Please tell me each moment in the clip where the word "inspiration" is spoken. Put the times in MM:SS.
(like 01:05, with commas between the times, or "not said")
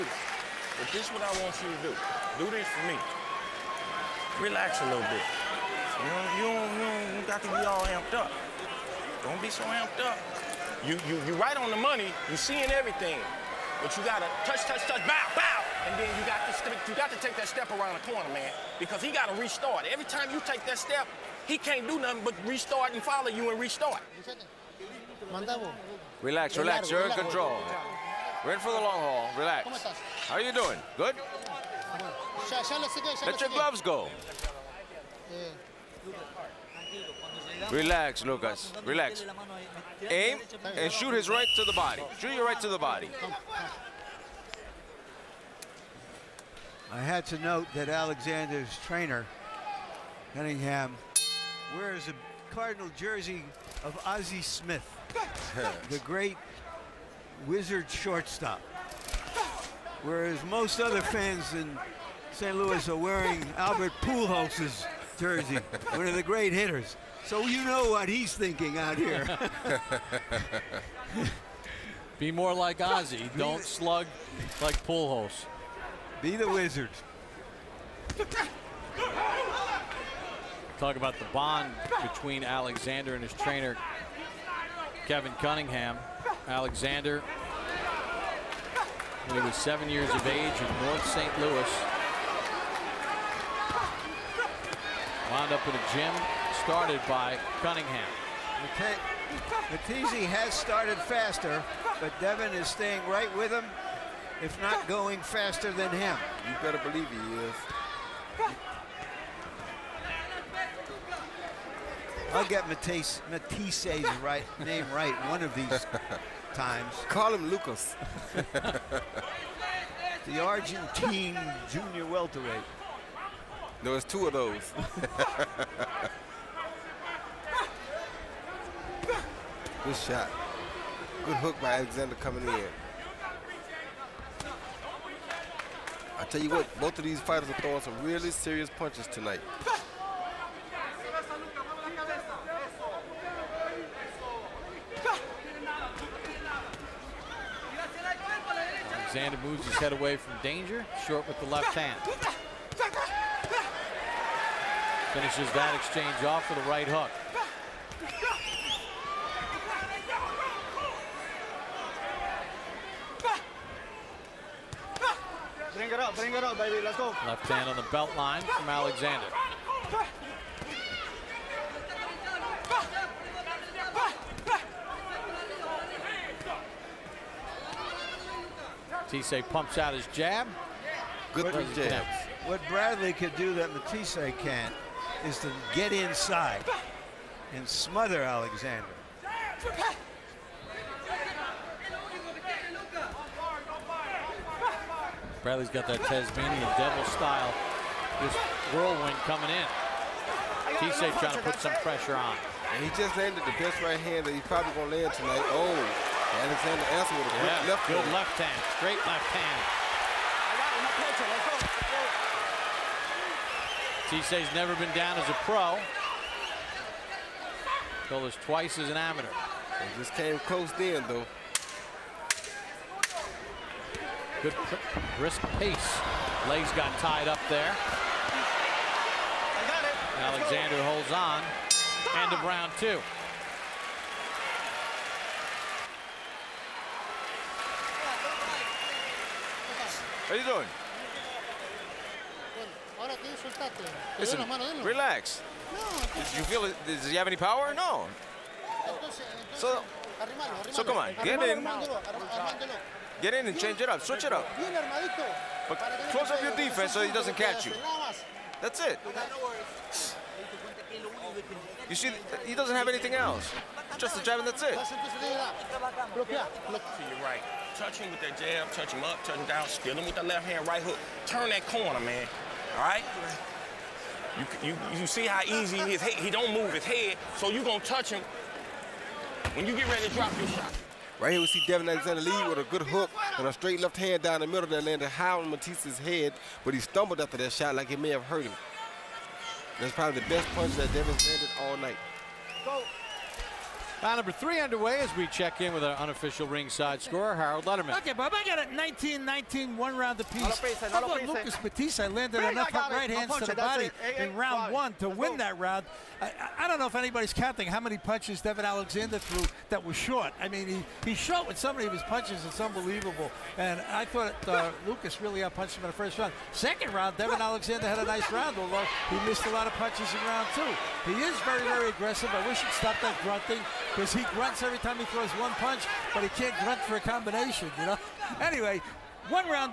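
not said.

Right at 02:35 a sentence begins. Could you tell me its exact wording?
Finishes that exchange off with a right hook.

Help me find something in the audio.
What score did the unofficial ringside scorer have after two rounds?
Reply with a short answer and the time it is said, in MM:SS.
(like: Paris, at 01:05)
19-19, at 04:58.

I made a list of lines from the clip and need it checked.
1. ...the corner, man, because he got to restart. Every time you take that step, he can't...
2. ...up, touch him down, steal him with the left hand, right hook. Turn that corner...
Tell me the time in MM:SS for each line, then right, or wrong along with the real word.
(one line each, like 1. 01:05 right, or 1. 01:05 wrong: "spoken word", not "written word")
1. 00:18 right
2. 04:29 right.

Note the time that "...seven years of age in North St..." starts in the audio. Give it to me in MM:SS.
01:29.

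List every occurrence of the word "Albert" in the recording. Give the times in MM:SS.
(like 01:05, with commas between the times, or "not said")
01:03.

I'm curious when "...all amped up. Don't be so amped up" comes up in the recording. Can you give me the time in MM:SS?
00:07.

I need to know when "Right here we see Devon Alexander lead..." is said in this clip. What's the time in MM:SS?
04:41.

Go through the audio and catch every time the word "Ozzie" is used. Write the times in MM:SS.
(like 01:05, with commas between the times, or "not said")
00:54, 01:12.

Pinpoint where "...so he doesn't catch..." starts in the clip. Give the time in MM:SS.
04:16.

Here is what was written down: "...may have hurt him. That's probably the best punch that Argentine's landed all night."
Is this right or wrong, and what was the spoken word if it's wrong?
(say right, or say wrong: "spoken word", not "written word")
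wrong: "Devon", not "Argentine".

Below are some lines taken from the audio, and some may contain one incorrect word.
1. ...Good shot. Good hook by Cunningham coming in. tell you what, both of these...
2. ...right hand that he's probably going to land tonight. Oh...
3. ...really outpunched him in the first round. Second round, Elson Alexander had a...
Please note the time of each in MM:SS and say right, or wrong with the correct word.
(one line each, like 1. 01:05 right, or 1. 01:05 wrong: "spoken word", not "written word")
1. 02:09 wrong: "Alexander", not "Cunningham"
2. 03:23 right
3. 05:15 wrong: "Devon", not "Elson".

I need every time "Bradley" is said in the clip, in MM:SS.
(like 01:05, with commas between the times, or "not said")
03:02, 03:15.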